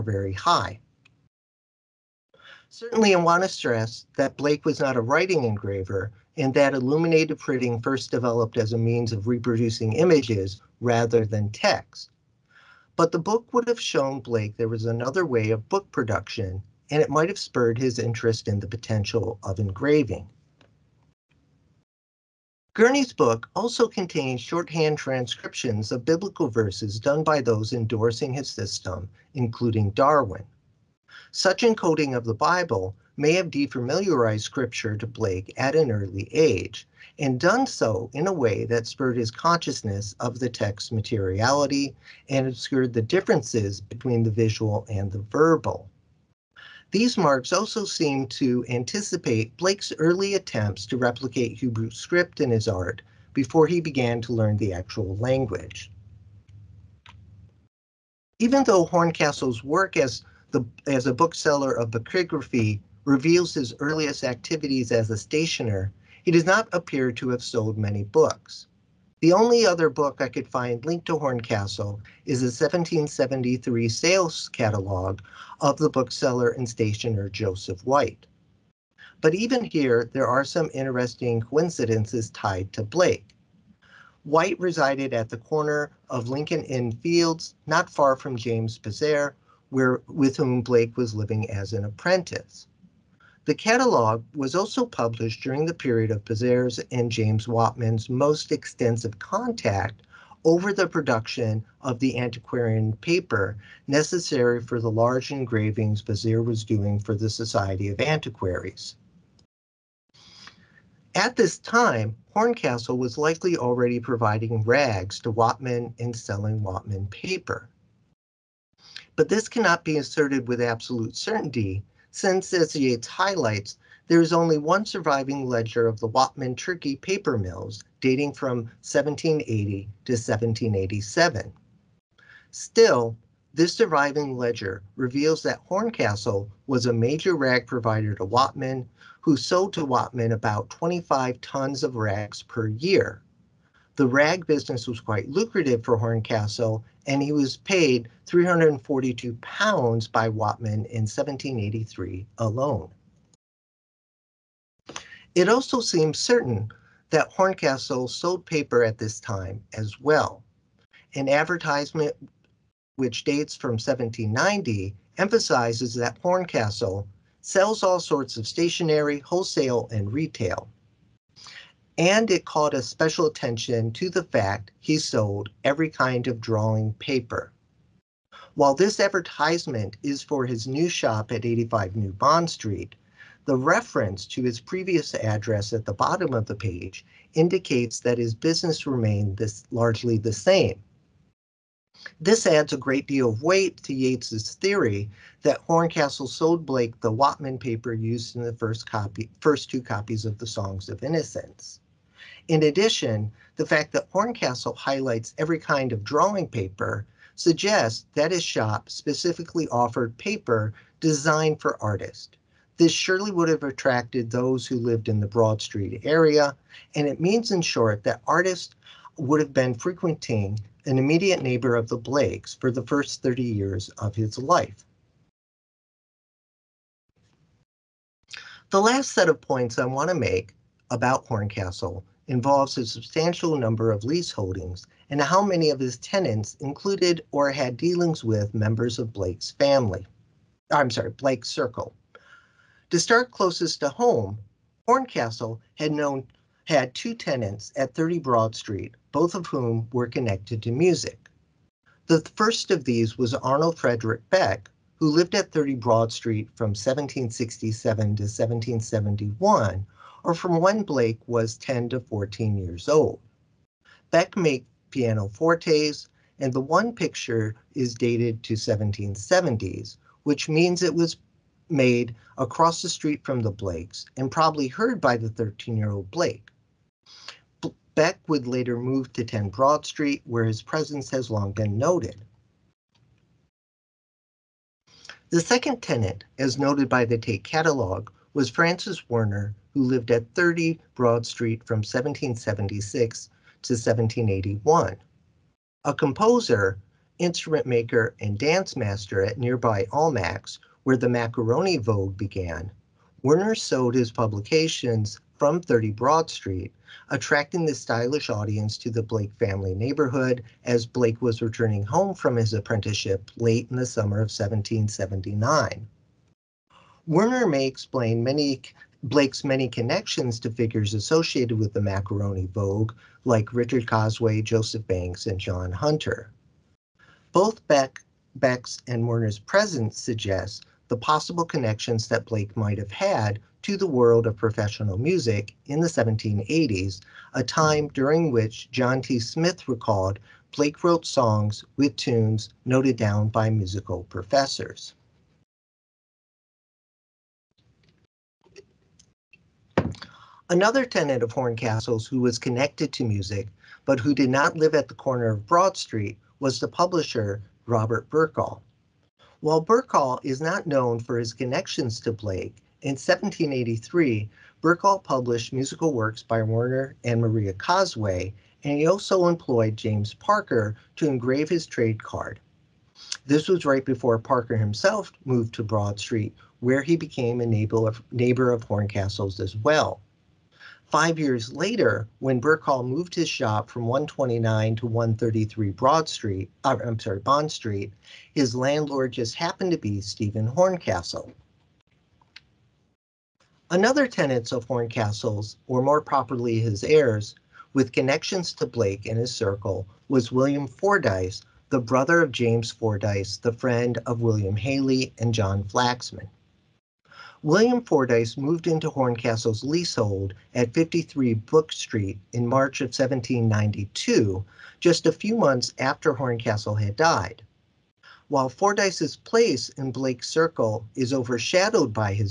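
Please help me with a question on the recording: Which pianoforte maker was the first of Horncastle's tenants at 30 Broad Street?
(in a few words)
Arnold Frederick Beck.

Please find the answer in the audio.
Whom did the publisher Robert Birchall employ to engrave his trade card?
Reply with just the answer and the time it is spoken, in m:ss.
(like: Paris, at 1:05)
James Parker, at 6:09.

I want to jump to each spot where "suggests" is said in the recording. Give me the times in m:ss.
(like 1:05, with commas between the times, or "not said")
3:27, 5:29.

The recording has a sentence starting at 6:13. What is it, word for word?
This was right before Parker himself moved to Broad Street, where he became a neighbor of, neighbor of Horncastle's as well.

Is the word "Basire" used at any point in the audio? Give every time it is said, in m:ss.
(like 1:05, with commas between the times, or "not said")
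1:28, 1:36.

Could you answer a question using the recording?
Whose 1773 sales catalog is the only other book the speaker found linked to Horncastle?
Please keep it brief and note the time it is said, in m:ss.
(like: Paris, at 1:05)
Joseph White, at 1:17.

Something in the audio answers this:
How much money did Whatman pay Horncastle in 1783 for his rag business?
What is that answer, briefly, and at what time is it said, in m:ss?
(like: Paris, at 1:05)
342 pounds, at 2:28.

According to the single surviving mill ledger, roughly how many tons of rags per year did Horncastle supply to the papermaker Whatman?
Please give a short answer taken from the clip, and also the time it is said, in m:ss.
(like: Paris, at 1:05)
25 tons, at 2:20.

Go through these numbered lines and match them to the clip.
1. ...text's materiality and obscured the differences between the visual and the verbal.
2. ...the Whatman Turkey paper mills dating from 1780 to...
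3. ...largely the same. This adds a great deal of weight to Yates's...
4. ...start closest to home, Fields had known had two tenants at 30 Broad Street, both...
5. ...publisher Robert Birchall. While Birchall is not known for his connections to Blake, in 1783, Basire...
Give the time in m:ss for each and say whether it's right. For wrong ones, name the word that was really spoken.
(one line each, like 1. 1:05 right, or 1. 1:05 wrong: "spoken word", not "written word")
1. 0:40 right
2. 2:06 right
3. 3:09 right
4. 4:02 wrong: "Horncastle", not "Fields"
5. 5:56 wrong: "Birchall", not "Basire".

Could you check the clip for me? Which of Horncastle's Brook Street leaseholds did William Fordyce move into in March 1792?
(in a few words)
53 Brook Street.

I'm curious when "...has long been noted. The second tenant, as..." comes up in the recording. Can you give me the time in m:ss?
4:41.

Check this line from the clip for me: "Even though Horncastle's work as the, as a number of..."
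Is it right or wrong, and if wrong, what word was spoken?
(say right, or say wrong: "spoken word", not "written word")
wrong: "bookseller", not "number".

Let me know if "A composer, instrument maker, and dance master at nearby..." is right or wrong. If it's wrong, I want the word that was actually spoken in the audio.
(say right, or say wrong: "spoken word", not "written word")
right.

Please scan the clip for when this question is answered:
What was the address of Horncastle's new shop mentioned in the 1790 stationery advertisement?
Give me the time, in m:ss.
3:01.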